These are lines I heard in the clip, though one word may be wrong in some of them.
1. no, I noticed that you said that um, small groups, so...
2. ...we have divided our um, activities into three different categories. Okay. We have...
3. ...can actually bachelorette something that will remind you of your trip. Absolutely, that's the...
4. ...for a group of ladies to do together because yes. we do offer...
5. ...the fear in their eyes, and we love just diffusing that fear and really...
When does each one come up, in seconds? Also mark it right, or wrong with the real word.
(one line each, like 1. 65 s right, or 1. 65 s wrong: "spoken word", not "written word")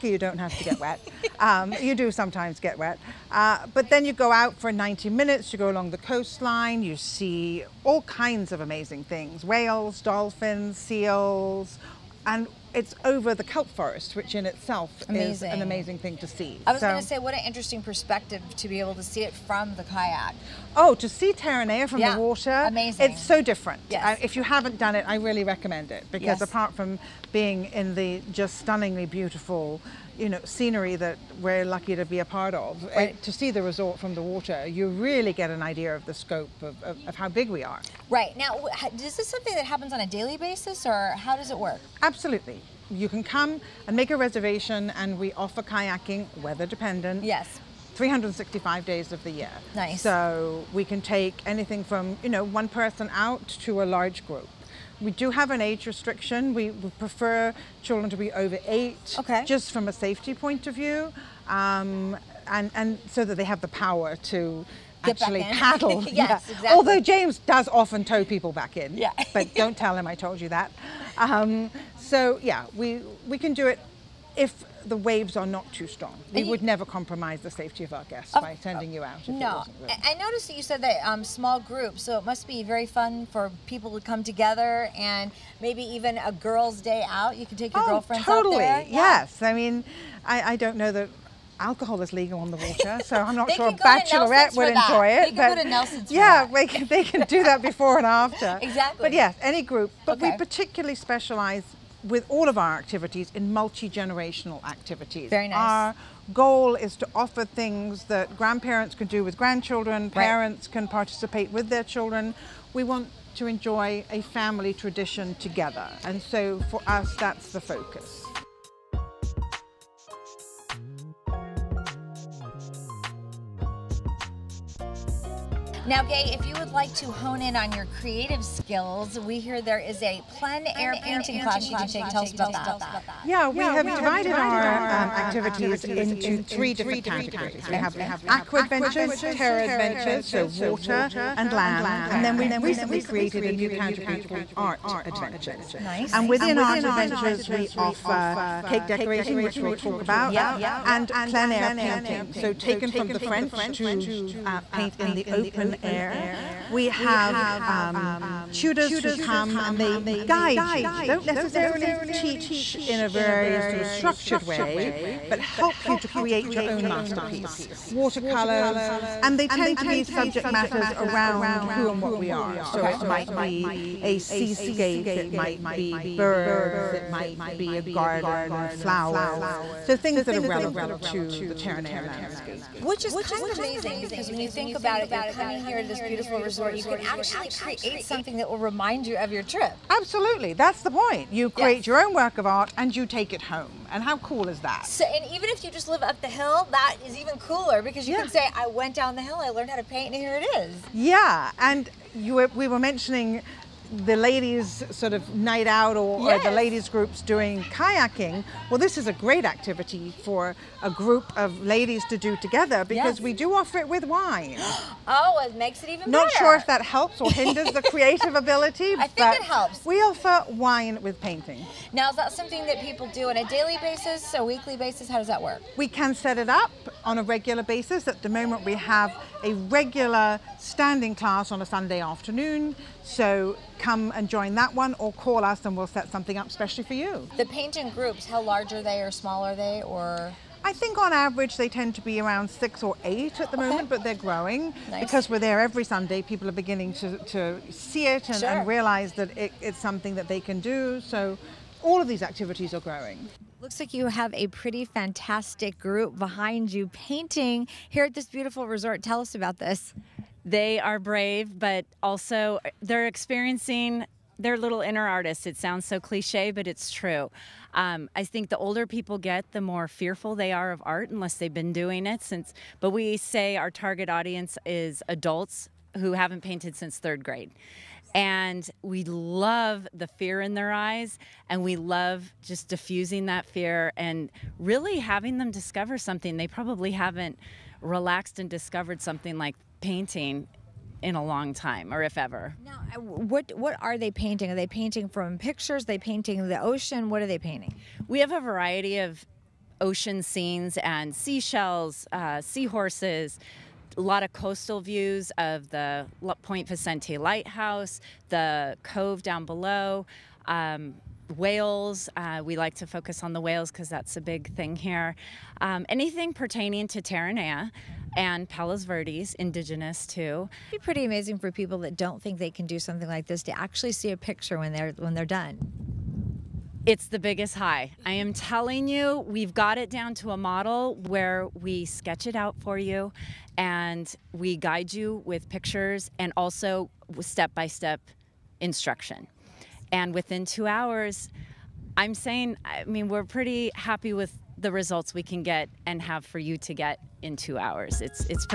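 1. 79 s right
2. 133 s right
3. 186 s wrong: "create", not "bachelorette"
4. 210 s right
5. 279 s right.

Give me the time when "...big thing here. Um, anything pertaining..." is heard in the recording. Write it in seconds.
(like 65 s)
314 s.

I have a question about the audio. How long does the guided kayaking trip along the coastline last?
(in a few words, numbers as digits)
90 minutes.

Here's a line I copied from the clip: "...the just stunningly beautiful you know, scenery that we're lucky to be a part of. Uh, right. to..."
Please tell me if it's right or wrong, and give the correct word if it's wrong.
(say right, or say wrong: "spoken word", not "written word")
right.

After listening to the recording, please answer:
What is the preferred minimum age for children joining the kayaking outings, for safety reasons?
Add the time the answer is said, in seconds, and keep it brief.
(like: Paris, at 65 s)
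over 8, at 58 s.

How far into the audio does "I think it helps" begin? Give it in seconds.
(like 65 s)
218 s.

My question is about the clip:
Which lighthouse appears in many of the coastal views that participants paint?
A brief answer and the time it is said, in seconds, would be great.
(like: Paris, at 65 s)
Point Vicente Lighthouse, at 306 s.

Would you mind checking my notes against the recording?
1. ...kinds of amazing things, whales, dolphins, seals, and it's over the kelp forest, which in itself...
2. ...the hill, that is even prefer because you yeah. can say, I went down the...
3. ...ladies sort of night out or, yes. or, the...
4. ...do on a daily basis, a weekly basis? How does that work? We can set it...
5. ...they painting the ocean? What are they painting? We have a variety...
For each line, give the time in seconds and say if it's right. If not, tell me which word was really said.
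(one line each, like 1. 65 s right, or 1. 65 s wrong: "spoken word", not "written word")
1. 8 s right
2. 196 s wrong: "cooler", not "prefer"
3. 204 s right
4. 223 s right
5. 295 s right.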